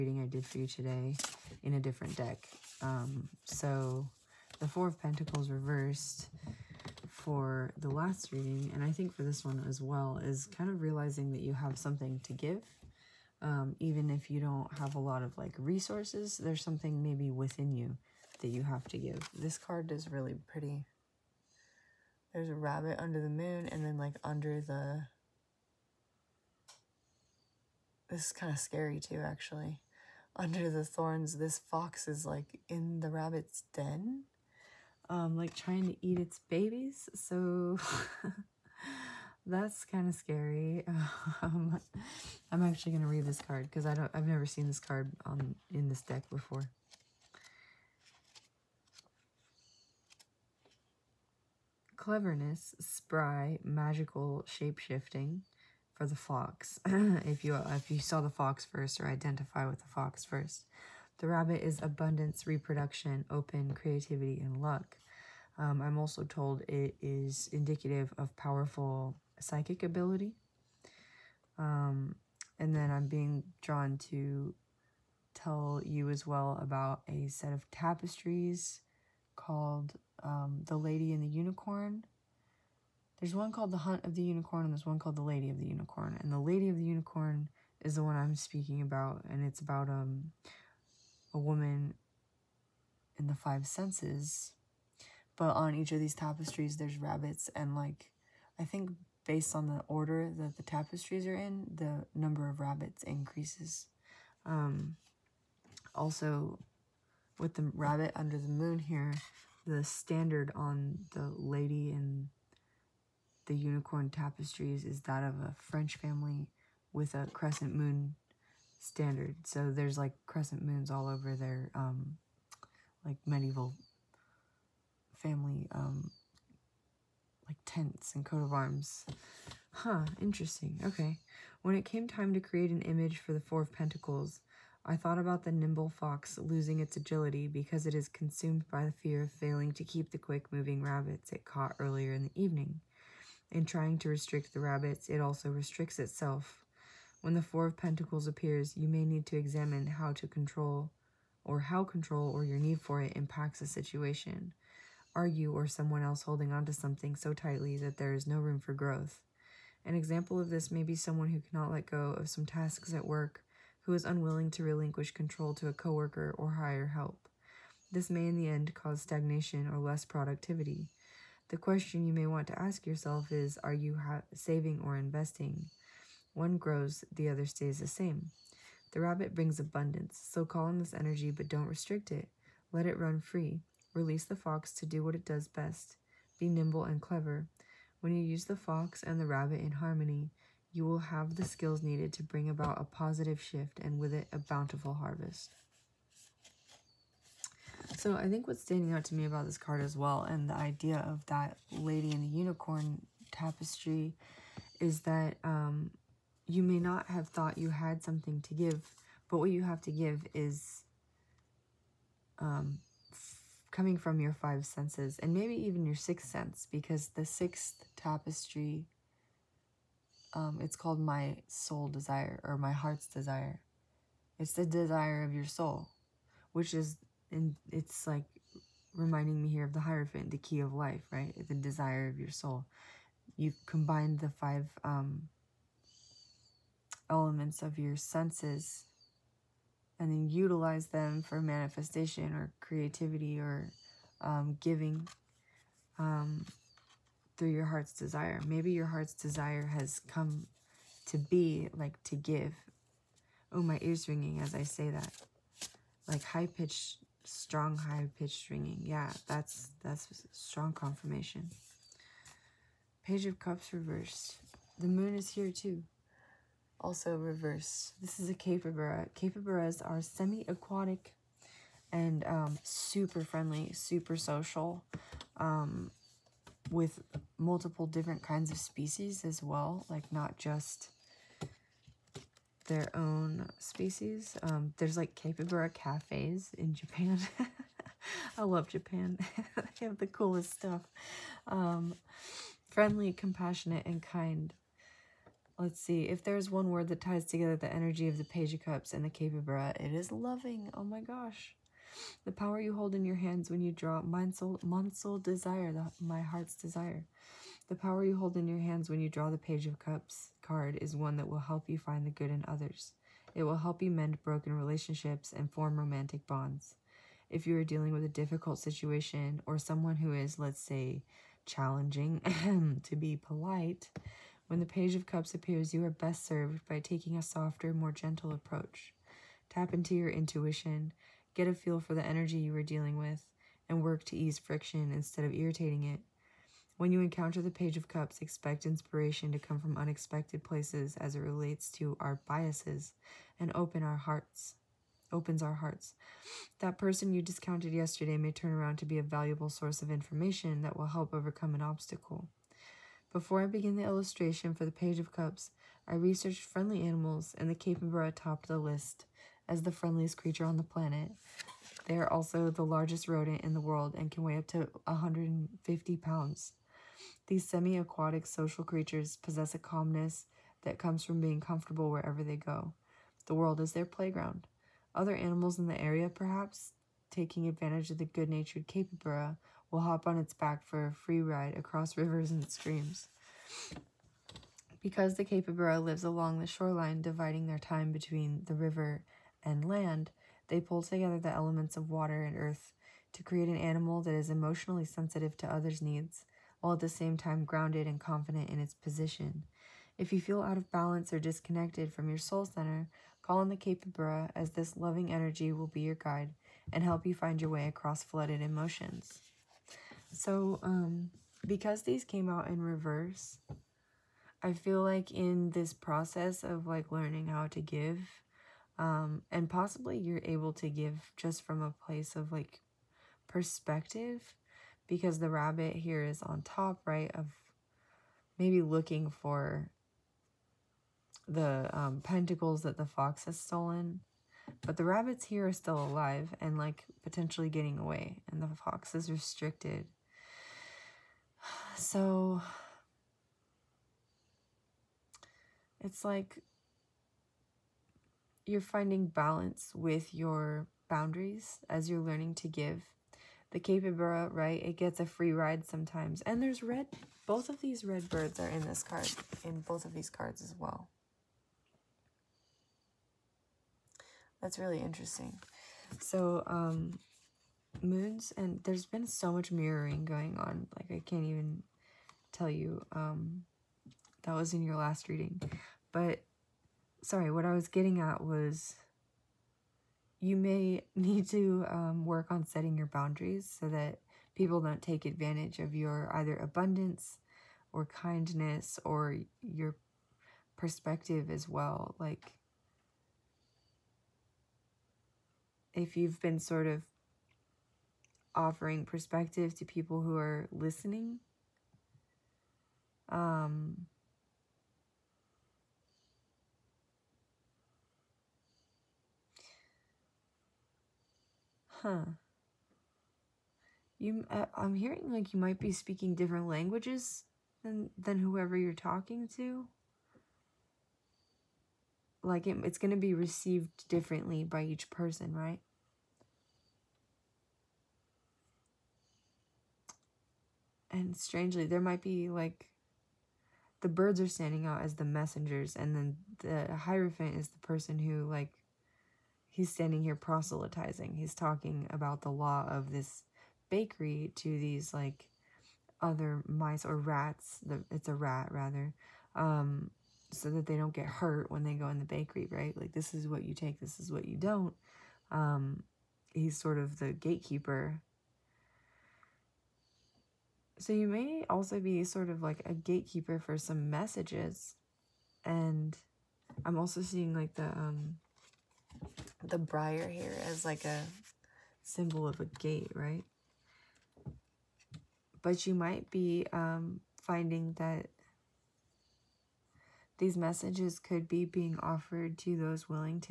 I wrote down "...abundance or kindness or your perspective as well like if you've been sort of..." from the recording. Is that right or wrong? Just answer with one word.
right.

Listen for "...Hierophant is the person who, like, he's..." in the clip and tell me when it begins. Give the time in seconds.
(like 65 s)
536 s.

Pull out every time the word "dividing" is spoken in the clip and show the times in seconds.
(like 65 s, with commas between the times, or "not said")
387 s.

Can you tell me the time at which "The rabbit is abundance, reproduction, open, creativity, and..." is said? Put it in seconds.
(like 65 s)
61 s.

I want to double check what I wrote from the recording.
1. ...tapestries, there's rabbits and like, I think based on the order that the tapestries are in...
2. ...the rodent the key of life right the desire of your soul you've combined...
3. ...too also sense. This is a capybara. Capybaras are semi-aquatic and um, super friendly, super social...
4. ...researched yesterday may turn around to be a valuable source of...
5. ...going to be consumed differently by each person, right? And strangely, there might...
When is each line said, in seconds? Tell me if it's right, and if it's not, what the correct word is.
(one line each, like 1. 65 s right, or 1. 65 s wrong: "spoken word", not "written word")
1. 96 s right
2. 229 s wrong: "hierophant", not "rodent"
3. 265 s wrong: "reverse", not "sense"
4. 347 s wrong: "discounted", not "researched"
5. 522 s wrong: "received", not "consumed".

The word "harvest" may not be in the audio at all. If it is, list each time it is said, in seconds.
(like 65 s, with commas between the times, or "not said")
194 s.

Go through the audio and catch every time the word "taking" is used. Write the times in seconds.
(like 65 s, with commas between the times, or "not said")
326 s, 377 s.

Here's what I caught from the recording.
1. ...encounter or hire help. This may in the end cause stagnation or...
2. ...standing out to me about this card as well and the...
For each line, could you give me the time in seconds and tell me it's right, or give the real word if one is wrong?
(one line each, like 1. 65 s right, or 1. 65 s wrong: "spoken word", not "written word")
1. 165 s wrong: "coworker", not "encounter"
2. 198 s right.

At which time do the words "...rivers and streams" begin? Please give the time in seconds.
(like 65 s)
381 s.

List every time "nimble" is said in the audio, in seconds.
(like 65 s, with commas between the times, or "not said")
135 s, 186 s.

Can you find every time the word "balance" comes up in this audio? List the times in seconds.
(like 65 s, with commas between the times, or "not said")
400 s, 449 s.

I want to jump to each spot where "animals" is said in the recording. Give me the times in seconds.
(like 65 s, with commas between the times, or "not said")
356 s, 375 s, 393 s.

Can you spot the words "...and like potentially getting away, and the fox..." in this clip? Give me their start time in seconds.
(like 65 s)
436 s.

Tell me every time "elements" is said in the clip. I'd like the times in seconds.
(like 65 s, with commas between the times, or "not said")
237 s, 391 s.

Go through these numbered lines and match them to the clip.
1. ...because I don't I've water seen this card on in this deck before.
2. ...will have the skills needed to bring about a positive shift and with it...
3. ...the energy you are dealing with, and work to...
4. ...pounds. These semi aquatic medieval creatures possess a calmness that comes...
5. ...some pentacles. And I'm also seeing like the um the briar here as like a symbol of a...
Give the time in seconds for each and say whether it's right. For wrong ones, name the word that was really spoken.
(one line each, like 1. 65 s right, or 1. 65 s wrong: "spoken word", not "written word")
1. 43 s wrong: "never", not "water"
2. 190 s right
3. 331 s right
4. 365 s wrong: "social", not "medieval"
5. 563 s wrong: "messages", not "pentacles".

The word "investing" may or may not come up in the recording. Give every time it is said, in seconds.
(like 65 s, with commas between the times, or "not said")
174 s.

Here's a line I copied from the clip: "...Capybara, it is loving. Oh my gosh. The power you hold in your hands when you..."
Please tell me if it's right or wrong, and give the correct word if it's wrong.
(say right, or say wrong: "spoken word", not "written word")
right.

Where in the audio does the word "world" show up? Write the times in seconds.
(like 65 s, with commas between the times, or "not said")
363 s, 373 s.